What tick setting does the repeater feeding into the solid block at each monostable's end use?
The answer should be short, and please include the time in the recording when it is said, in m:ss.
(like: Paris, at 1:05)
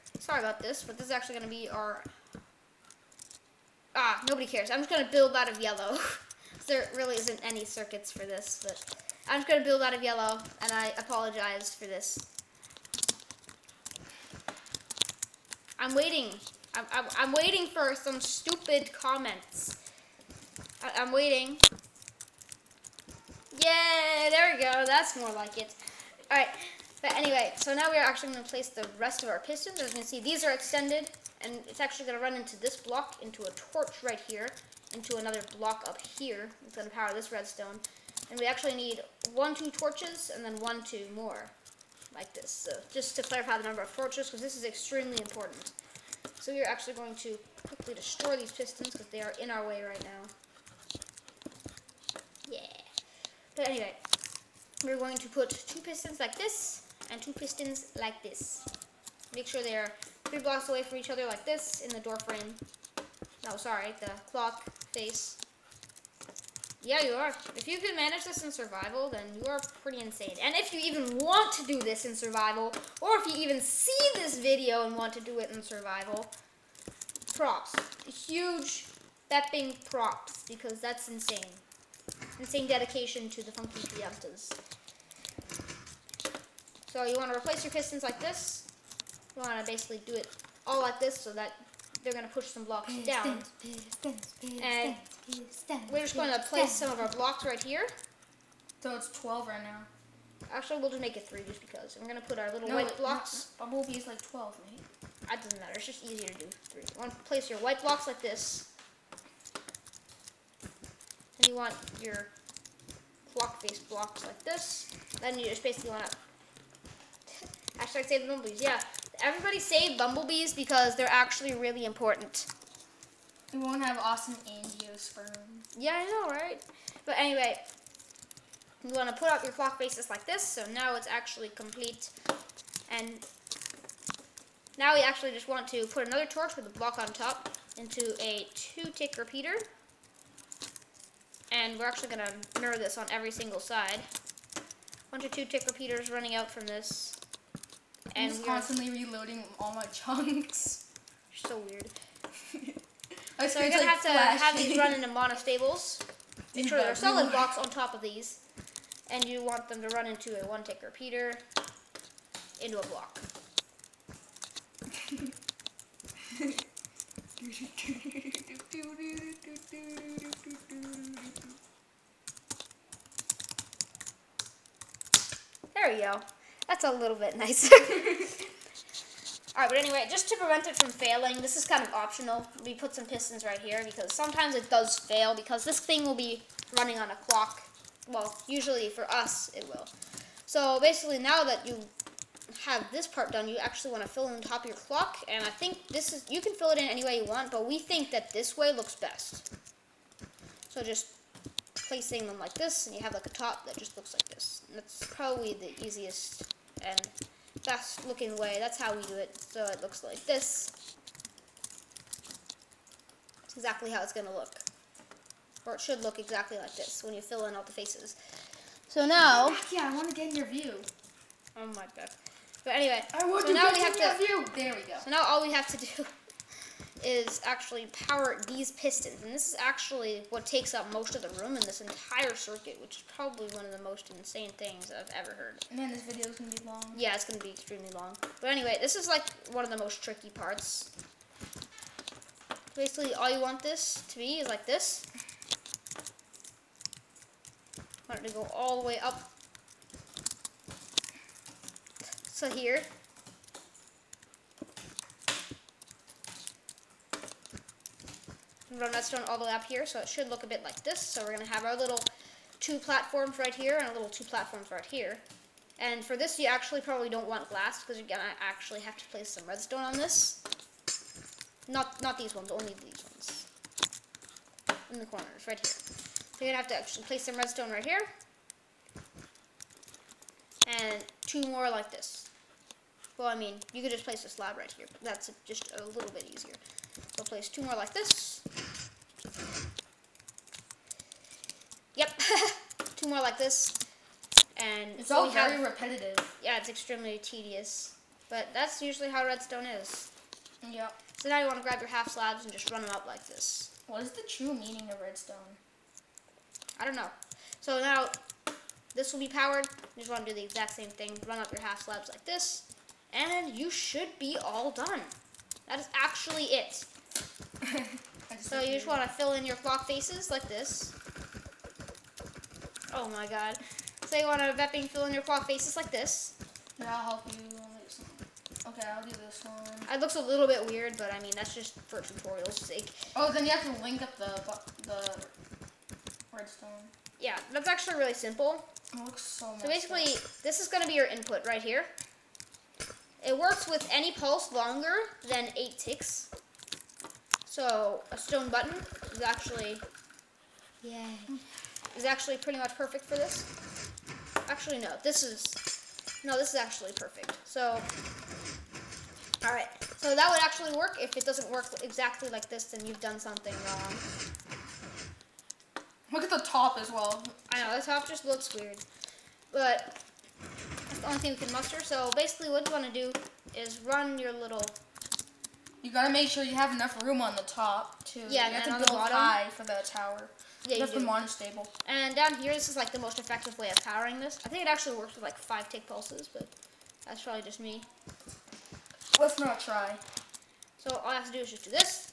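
one-tick, at 2:40.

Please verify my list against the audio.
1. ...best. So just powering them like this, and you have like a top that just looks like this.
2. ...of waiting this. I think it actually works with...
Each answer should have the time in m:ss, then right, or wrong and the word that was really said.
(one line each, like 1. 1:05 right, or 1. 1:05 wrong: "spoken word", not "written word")
1. 3:18 wrong: "placing", not "powering"
2. 6:23 wrong: "powering", not "waiting".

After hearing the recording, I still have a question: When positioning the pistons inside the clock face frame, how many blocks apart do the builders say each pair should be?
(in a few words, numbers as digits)
3 blocks.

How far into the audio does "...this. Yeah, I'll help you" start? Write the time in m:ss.
5:25.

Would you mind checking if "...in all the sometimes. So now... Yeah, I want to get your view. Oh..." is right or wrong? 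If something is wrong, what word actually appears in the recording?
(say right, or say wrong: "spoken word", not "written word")
wrong: "faces", not "sometimes".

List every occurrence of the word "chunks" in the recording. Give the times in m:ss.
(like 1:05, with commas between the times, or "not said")
2:29.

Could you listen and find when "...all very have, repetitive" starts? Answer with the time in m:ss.
4:55.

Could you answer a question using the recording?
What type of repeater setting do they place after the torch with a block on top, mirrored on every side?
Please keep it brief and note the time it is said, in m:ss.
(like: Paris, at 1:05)
two-tick, at 2:18.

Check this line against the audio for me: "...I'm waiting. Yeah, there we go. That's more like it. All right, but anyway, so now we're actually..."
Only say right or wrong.
right.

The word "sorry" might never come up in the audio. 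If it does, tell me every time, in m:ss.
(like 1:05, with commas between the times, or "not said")
1:03.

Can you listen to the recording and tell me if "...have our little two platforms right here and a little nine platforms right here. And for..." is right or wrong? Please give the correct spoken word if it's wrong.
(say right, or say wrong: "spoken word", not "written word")
wrong: "two", not "nine".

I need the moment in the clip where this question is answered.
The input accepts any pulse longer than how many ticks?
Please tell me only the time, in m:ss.
5:45.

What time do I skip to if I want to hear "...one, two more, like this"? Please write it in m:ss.
0:40.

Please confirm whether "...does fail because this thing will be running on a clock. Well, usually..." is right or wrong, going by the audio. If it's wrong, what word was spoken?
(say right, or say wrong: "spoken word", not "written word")
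right.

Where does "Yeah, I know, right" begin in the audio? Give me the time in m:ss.
2:05.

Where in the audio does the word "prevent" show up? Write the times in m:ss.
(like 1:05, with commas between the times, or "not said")
3:00.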